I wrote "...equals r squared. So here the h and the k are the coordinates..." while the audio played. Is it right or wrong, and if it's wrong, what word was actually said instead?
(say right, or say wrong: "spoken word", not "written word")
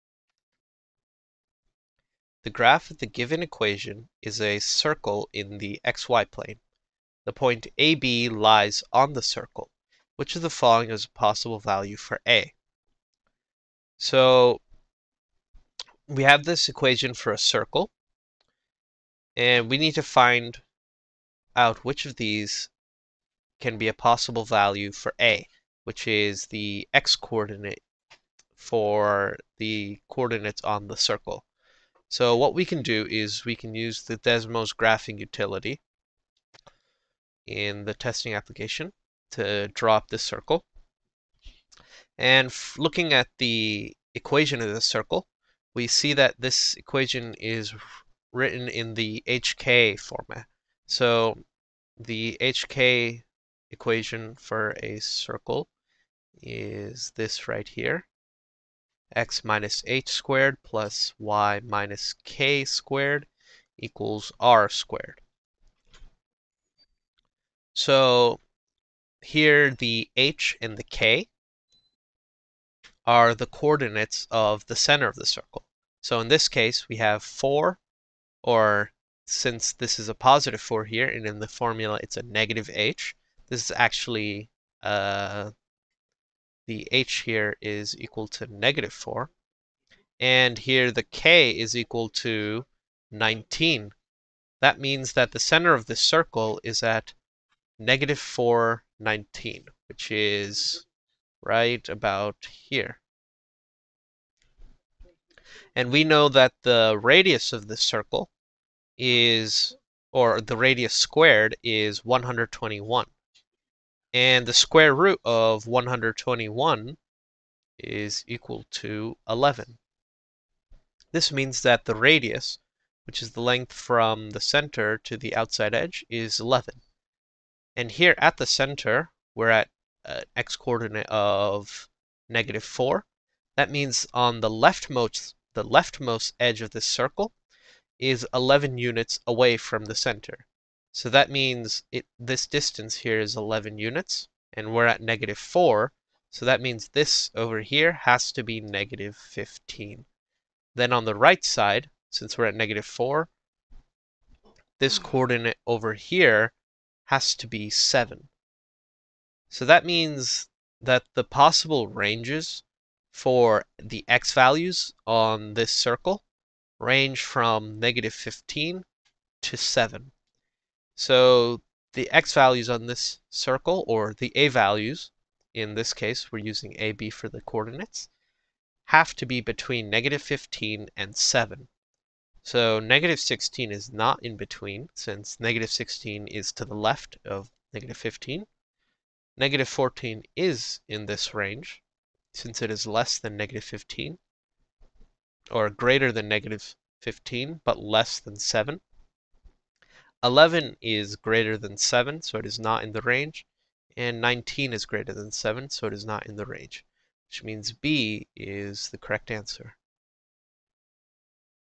right.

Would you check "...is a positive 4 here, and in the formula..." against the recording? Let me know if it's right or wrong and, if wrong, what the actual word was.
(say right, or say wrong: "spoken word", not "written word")
right.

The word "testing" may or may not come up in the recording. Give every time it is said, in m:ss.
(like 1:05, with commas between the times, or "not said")
0:37.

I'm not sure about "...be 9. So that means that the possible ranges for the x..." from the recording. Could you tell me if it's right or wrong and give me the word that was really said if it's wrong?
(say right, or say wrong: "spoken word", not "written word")
wrong: "7", not "9".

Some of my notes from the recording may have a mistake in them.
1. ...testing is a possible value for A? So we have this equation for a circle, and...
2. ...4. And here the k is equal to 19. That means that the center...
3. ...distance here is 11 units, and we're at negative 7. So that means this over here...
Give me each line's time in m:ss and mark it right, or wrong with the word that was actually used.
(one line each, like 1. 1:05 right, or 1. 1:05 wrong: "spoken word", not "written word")
1. 0:10 wrong: "following", not "testing"
2. 1:28 right
3. 2:22 wrong: "4", not "7".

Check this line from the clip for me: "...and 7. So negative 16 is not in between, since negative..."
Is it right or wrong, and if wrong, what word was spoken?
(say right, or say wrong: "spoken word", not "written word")
right.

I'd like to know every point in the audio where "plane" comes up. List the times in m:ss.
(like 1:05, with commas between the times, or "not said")
0:06.